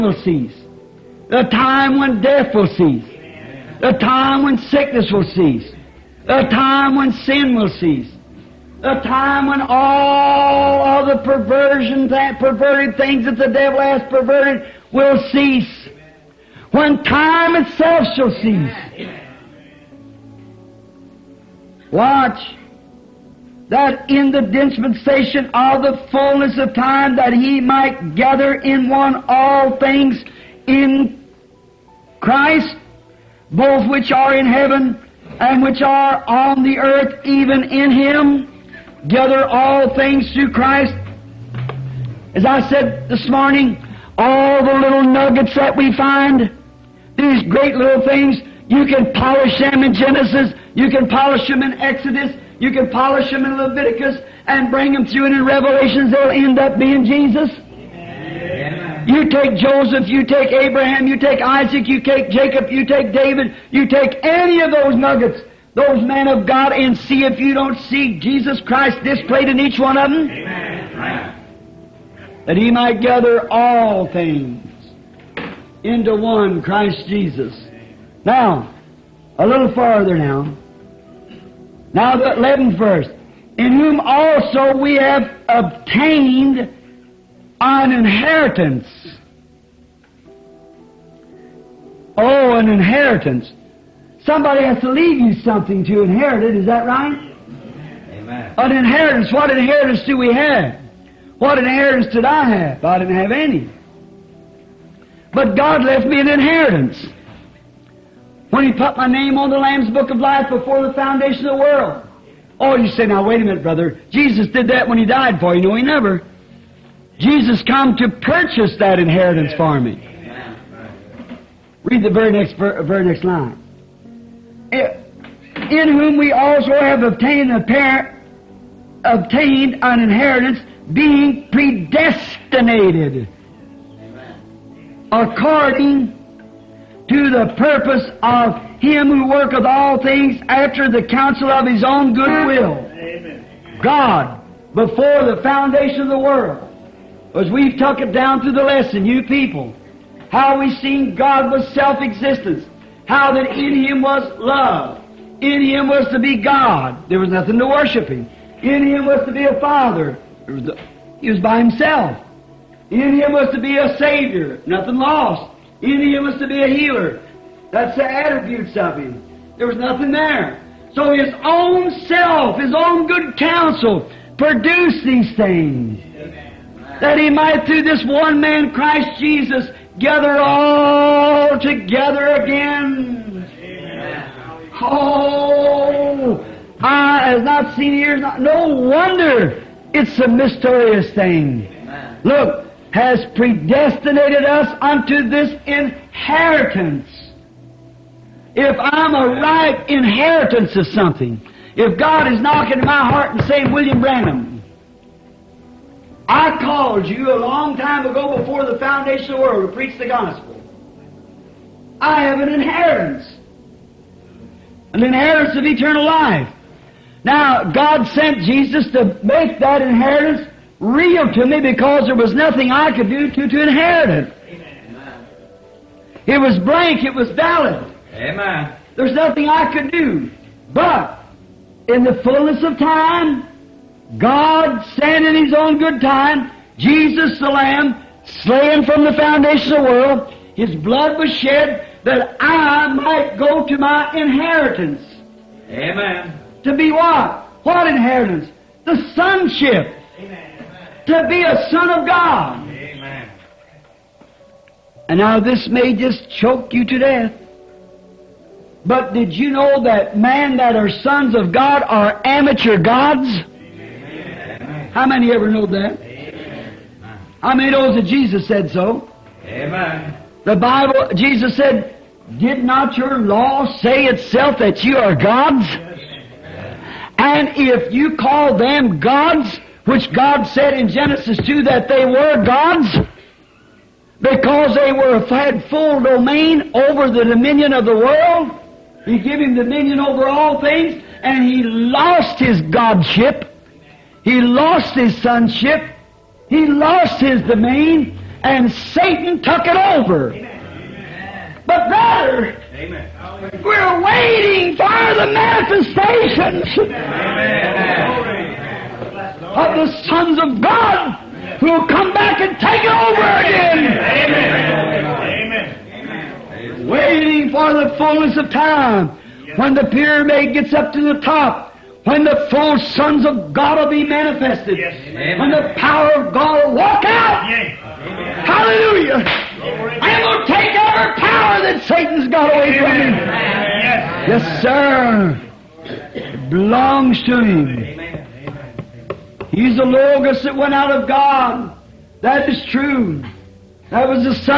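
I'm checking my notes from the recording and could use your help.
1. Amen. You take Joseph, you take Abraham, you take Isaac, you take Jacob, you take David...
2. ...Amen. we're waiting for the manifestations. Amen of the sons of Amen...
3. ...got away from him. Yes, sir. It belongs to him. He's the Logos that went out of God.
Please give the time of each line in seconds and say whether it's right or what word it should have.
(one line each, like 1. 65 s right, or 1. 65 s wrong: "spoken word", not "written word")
1. 57 s right
2. 302 s wrong: "God", not "Amen"
3. 332 s right.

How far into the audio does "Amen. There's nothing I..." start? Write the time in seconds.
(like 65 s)
228 s.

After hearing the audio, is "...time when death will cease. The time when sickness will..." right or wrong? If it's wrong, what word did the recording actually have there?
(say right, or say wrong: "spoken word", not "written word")
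right.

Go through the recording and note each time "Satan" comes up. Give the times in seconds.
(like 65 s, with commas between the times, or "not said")
298 s, 331 s.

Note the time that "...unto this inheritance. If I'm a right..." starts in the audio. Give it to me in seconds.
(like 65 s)
194 s.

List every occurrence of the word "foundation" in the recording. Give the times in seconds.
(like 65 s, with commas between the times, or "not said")
110 s, 145 s, 208 s, 239 s.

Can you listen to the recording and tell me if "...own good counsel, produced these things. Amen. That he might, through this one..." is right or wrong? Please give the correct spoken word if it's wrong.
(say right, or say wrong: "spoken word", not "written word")
right.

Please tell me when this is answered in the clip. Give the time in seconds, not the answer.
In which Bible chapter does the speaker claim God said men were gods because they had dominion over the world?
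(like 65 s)
280 s.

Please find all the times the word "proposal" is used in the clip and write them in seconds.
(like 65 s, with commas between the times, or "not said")
not said.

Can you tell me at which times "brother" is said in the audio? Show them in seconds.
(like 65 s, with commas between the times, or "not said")
113 s, 301 s.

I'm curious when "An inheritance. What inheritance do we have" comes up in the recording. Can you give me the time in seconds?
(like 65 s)
98 s.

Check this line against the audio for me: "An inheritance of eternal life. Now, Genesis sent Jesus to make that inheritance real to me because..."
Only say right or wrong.
wrong.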